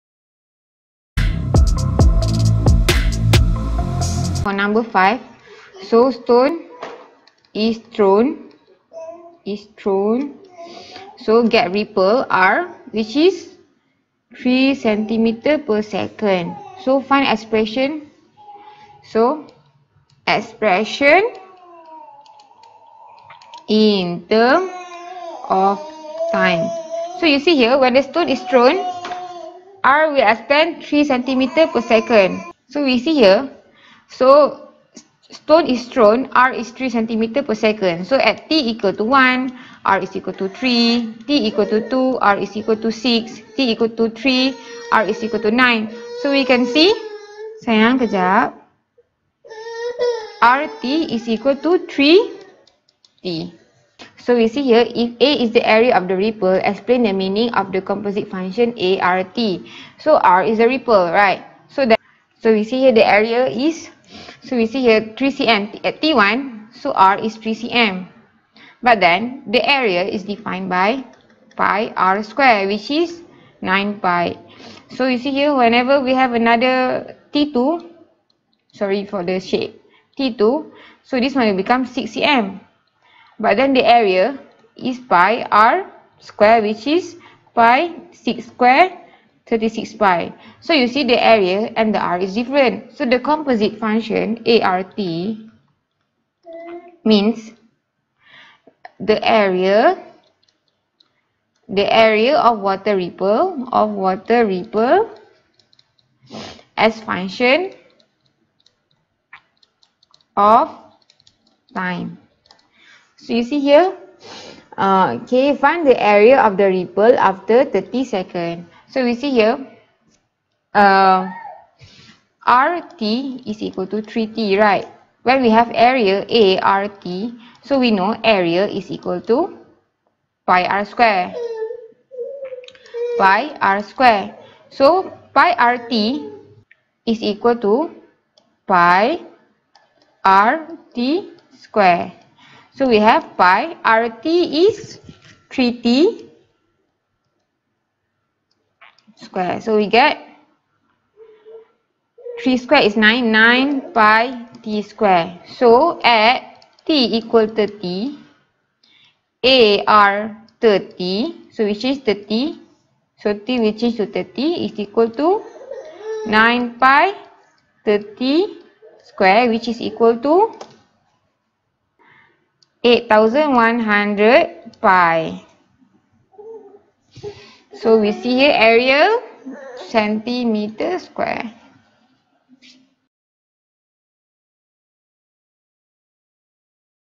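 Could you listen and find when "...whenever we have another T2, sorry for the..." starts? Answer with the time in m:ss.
1:15.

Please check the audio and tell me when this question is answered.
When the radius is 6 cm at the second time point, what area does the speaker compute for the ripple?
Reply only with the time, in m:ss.
1:29.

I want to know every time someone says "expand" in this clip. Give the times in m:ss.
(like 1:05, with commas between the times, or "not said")
0:30.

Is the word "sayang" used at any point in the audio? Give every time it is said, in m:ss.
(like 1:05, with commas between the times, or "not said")
0:47.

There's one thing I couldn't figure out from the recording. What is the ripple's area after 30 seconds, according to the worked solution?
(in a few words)
8100 pi.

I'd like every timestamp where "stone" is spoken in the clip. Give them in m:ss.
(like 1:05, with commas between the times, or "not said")
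0:06, 0:28, 0:35.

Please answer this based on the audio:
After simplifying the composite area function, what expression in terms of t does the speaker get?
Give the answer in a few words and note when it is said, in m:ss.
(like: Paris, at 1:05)
9 pi t squared, at 2:33.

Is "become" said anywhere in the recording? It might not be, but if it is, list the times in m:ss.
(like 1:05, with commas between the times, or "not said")
1:21.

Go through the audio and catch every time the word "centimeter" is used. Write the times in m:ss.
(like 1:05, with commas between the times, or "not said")
0:14, 0:31, 2:59.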